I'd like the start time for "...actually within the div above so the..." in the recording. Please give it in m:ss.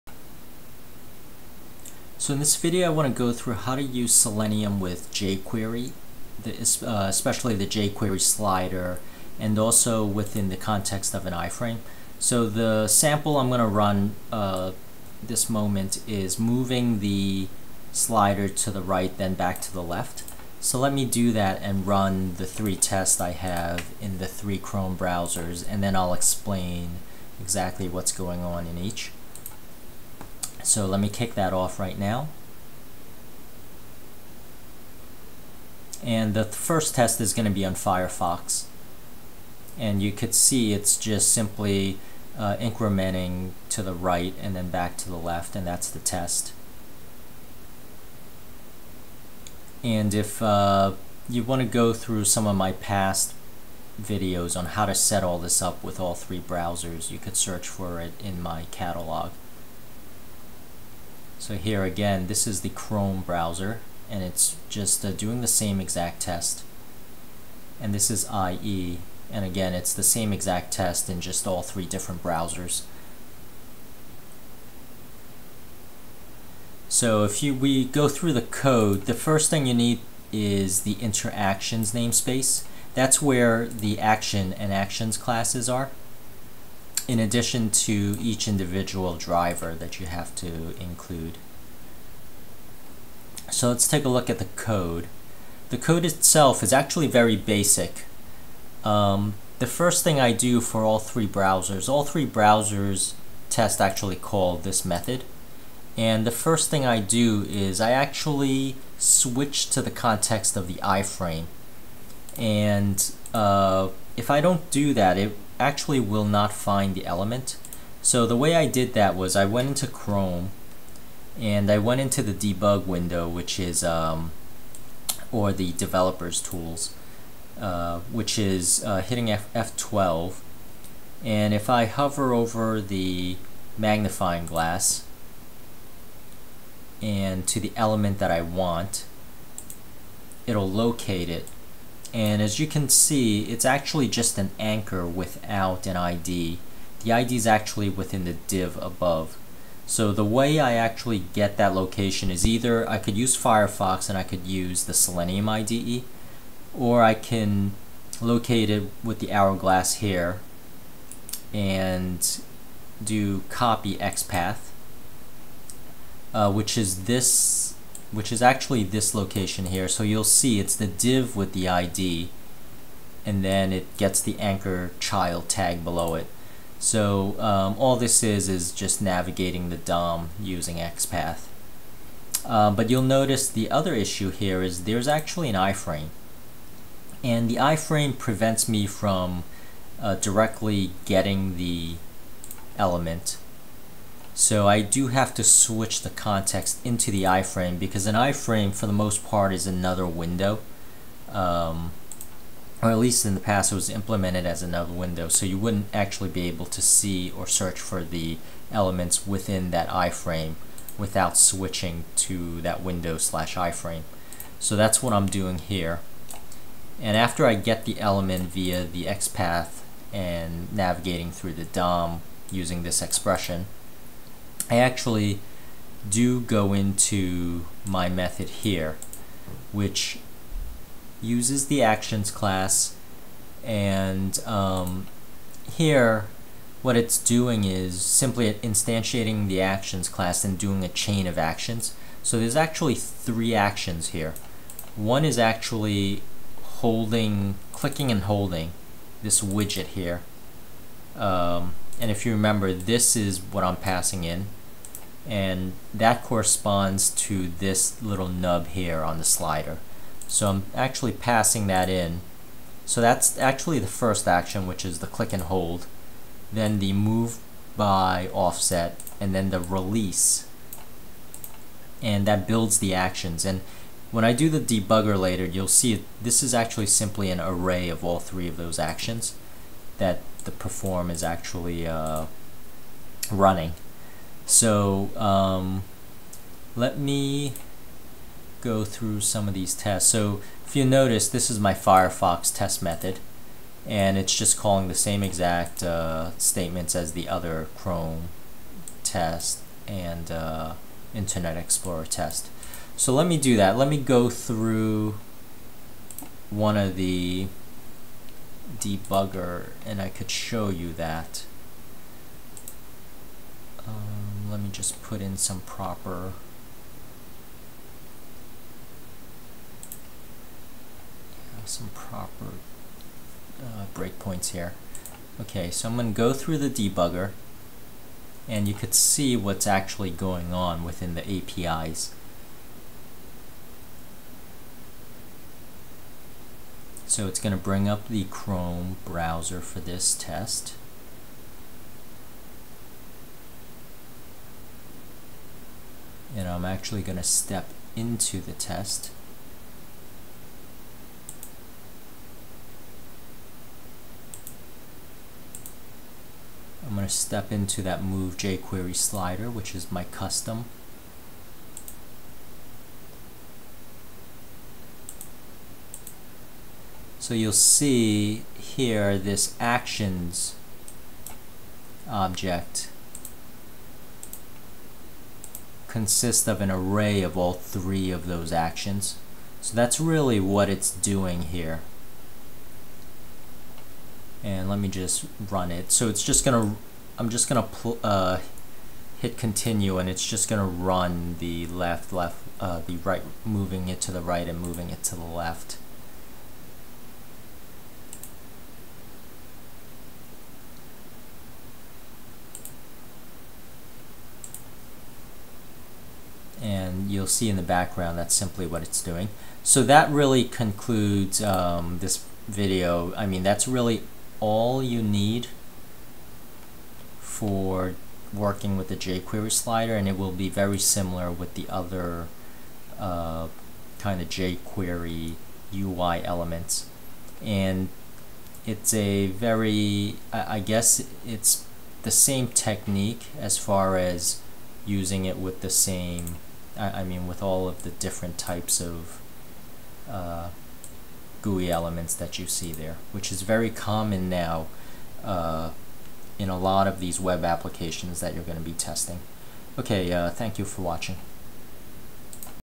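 2:27.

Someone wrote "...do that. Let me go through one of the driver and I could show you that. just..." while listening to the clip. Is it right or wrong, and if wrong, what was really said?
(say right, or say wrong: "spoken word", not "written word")
wrong: "debugger", not "driver".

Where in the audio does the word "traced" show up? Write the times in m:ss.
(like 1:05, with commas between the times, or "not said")
not said.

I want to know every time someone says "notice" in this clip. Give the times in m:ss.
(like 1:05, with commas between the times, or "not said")
3:03, 4:50.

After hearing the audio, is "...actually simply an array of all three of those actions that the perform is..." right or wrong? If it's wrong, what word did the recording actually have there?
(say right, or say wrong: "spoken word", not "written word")
right.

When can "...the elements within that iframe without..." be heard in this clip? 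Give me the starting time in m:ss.
3:28.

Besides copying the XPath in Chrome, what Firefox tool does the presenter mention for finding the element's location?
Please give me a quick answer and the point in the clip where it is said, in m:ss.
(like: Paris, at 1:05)
Selenium IDE, at 2:34.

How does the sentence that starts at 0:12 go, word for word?
So the sample I'm going to run uh, this moment is moving the slider to the right, then back to the left.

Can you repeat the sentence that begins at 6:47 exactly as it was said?
you'll see in the background that's simply what it's doing.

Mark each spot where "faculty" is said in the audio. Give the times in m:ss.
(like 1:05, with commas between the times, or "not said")
not said.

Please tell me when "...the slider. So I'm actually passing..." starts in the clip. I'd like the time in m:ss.
4:19.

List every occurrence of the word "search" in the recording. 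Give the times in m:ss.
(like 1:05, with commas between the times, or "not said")
0:57, 3:27.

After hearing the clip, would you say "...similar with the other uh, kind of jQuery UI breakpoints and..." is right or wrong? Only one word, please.
wrong.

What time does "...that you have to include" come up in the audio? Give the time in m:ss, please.
1:29.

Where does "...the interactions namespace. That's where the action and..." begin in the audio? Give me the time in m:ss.
1:20.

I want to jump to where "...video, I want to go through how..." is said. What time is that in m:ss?
0:02.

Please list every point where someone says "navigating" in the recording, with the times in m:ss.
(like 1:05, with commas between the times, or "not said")
2:59, 3:40.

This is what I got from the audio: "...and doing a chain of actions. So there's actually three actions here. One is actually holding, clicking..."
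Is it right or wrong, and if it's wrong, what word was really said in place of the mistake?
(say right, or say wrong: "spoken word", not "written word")
right.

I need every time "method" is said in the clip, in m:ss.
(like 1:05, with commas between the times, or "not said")
1:44, 3:48, 4:52.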